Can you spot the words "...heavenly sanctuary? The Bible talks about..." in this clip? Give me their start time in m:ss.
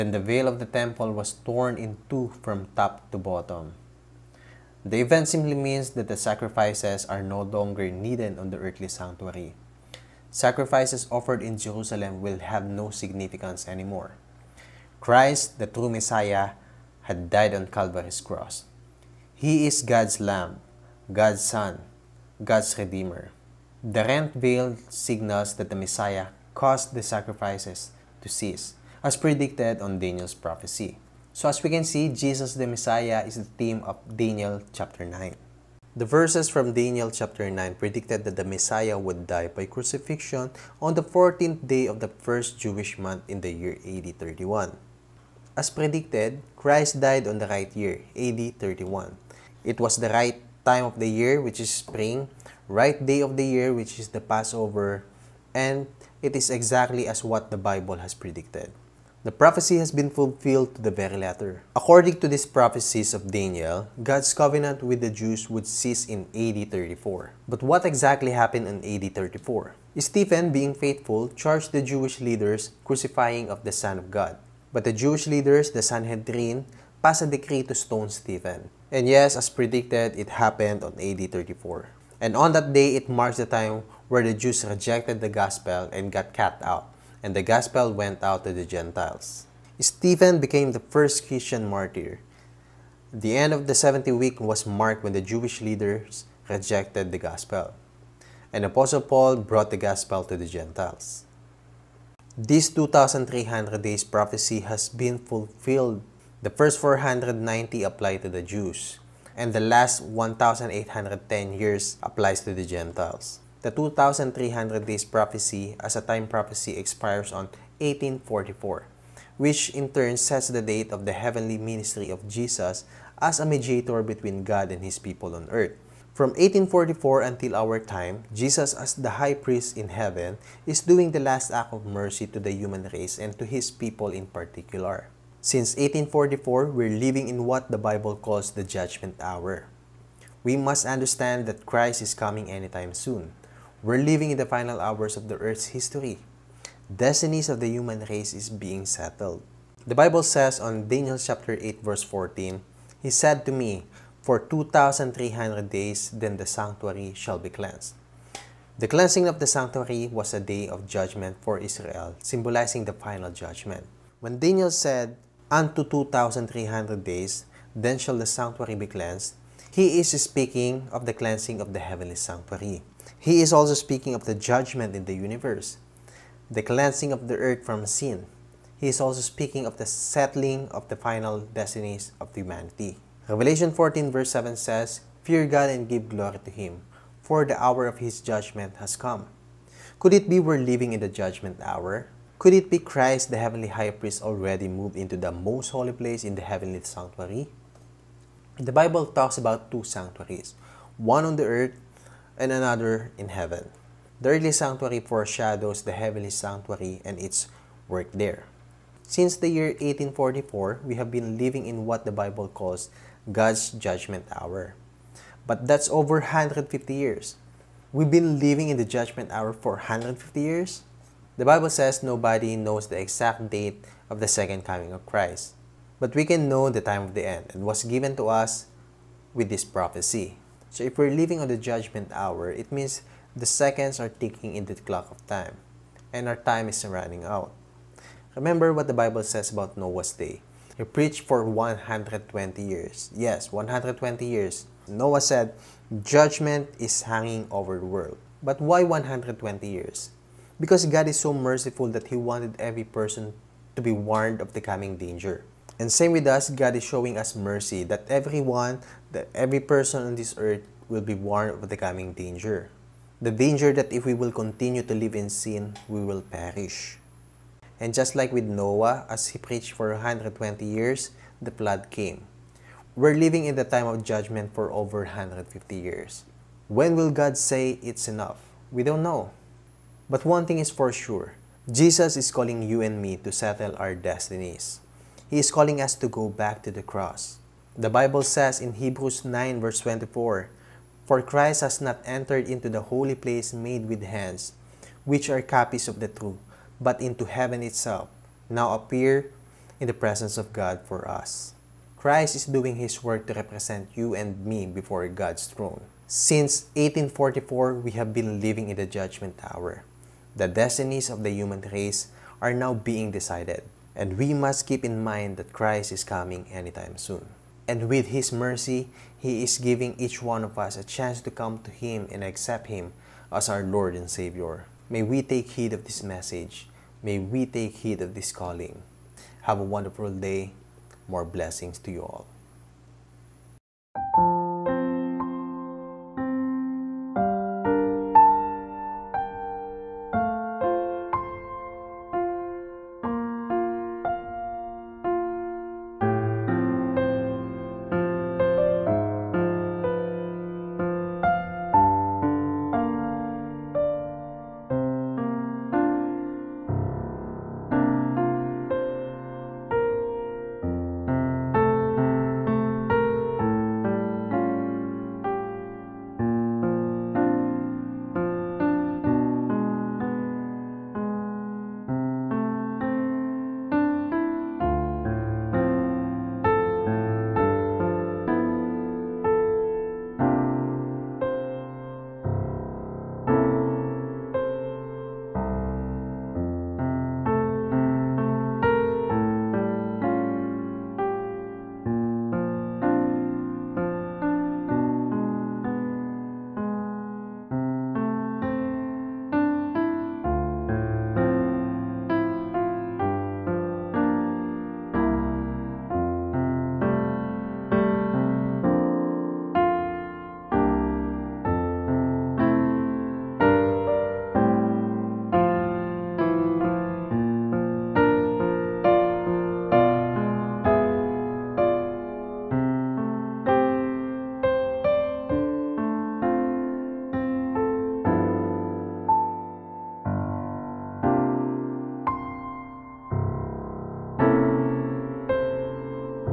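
3:16.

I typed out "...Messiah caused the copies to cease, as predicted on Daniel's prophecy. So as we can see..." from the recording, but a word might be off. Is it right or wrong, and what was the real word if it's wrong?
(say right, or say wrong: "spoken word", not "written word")
wrong: "sacrifices", not "copies".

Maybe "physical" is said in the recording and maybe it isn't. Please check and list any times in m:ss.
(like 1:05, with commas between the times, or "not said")
not said.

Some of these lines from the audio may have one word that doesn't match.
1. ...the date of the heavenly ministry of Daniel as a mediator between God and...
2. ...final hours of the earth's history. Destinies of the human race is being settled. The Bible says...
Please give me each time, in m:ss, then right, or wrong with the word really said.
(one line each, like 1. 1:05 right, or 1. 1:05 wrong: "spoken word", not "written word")
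1. 2:00 wrong: "Jesus", not "Daniel"
2. 2:24 right.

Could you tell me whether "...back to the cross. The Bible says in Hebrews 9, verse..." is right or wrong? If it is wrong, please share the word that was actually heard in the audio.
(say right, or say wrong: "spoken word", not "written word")
right.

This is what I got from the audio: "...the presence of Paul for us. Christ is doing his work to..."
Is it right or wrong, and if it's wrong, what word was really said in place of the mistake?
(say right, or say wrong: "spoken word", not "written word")
wrong: "God", not "Paul".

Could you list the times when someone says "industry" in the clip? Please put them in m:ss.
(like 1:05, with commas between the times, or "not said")
not said.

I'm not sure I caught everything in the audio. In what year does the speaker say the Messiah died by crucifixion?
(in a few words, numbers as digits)
AD 31.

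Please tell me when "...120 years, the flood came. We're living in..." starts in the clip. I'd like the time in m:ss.
4:29.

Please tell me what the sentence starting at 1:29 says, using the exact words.
Stephen became the first Christian martyr.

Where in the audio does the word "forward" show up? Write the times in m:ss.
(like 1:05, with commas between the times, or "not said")
not said.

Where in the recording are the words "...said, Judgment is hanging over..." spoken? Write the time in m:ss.
4:05.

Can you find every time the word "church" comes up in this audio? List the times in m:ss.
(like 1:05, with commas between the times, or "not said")
not said.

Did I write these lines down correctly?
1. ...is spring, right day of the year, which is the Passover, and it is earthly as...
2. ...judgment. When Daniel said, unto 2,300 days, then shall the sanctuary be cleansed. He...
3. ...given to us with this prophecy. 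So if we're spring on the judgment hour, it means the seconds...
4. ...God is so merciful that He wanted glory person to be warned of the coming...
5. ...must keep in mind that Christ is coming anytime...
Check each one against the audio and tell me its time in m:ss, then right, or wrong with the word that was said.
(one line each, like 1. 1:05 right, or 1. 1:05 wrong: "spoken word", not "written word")
1. 0:51 wrong: "exactly", not "earthly"
2. 2:43 right
3. 3:47 wrong: "living", not "spring"
4. 4:10 wrong: "every", not "glory"
5. 5:14 right.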